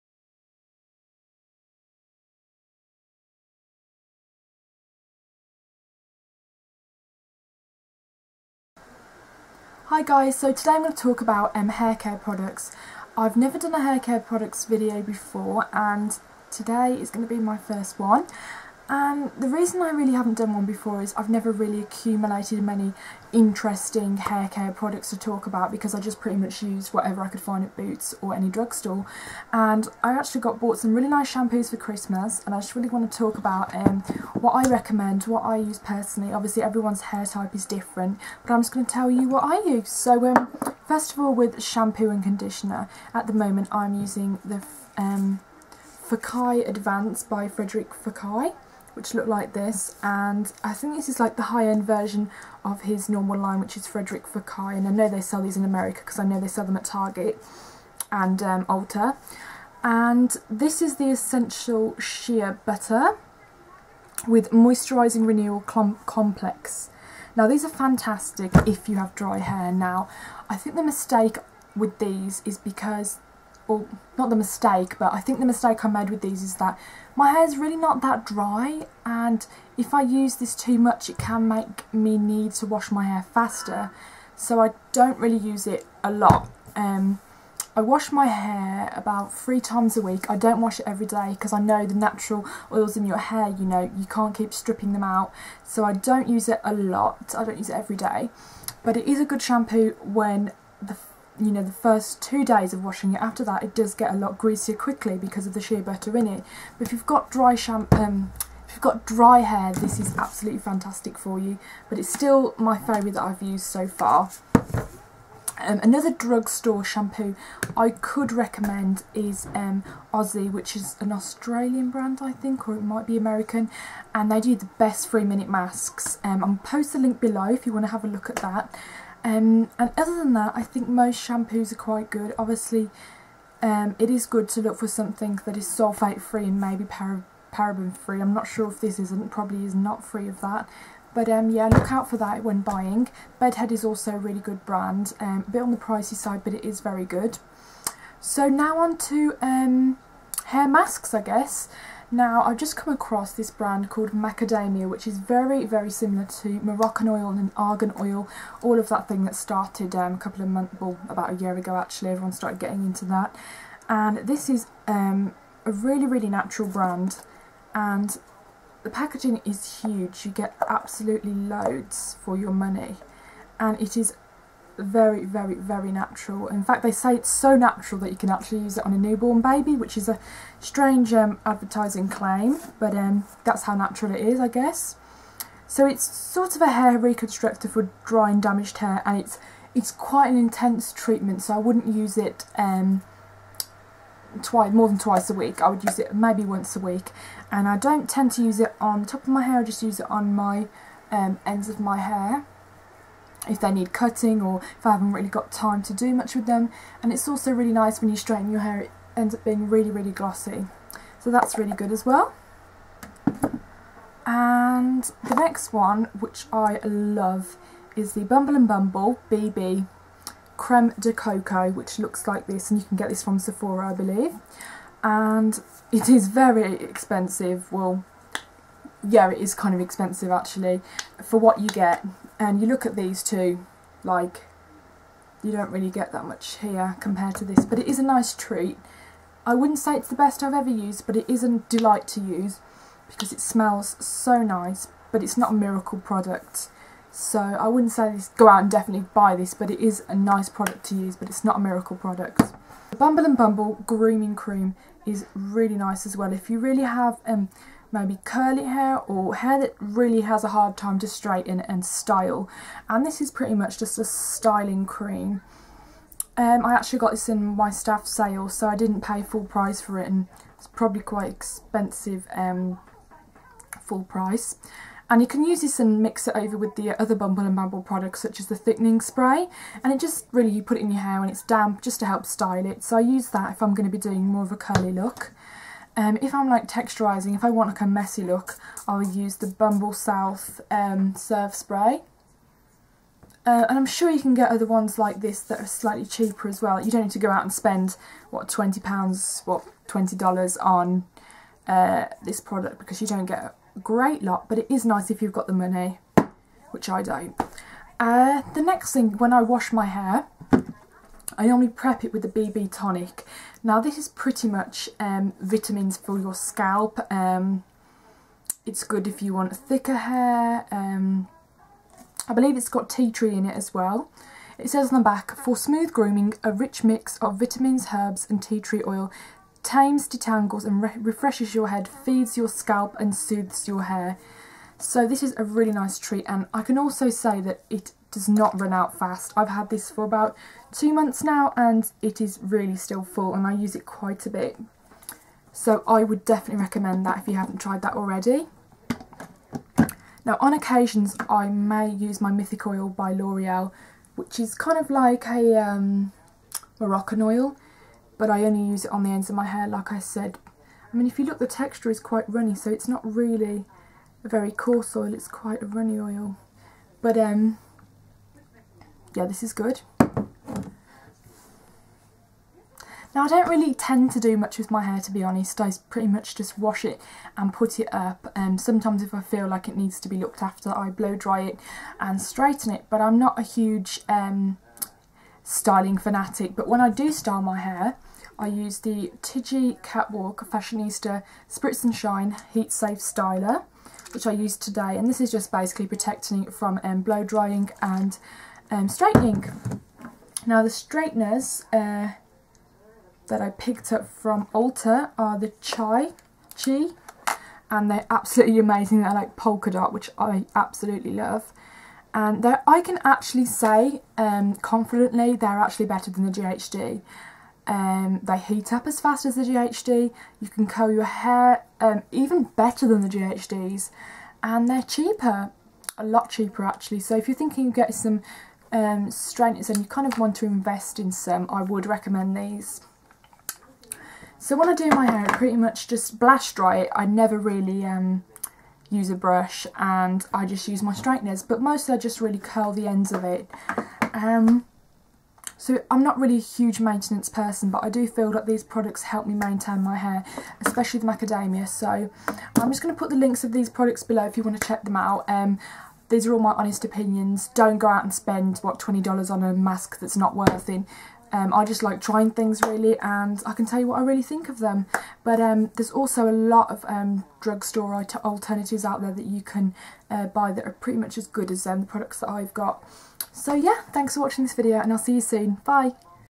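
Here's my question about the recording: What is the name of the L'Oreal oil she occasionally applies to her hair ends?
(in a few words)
Mythic Oil.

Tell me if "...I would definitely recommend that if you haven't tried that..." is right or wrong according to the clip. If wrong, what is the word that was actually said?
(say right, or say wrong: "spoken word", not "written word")
right.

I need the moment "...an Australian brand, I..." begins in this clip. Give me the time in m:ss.
2:00.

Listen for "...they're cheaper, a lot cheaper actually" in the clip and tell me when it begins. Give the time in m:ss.
7:04.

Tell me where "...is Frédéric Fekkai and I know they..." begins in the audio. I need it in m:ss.
0:53.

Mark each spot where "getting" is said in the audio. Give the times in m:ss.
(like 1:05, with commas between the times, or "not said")
2:42, 7:07.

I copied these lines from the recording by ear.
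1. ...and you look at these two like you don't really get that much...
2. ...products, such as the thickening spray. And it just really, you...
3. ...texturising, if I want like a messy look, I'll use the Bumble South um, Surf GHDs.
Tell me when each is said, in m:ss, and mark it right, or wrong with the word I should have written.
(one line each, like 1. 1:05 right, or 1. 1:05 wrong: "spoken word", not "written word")
1. 3:52 right
2. 4:37 right
3. 4:46 wrong: "Spray", not "GHDs".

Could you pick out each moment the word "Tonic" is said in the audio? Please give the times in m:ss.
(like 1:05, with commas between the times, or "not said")
5:12.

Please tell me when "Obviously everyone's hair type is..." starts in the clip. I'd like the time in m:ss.
0:36.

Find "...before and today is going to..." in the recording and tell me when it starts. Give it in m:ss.
0:15.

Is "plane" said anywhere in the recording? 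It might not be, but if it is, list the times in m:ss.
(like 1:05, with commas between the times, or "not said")
not said.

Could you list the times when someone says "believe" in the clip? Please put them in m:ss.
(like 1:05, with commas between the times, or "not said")
3:43, 5:22.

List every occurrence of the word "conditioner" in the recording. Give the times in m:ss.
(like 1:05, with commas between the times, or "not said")
0:42.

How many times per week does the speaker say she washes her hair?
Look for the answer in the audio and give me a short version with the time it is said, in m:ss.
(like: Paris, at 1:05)
3, at 1:29.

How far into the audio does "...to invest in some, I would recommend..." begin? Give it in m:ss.
7:10.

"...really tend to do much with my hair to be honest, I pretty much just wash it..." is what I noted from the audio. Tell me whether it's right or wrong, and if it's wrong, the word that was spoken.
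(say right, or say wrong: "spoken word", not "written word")
right.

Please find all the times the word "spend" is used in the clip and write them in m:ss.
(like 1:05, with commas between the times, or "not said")
4:57, 7:38.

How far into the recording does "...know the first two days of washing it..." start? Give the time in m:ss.
1:41.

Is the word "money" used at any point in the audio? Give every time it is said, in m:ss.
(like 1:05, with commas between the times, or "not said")
2:52, 5:05.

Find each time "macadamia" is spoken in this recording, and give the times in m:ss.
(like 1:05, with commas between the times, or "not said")
2:34, 7:31.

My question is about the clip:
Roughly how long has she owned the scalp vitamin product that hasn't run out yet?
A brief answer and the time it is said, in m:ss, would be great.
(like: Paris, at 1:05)
about two months, at 5:40.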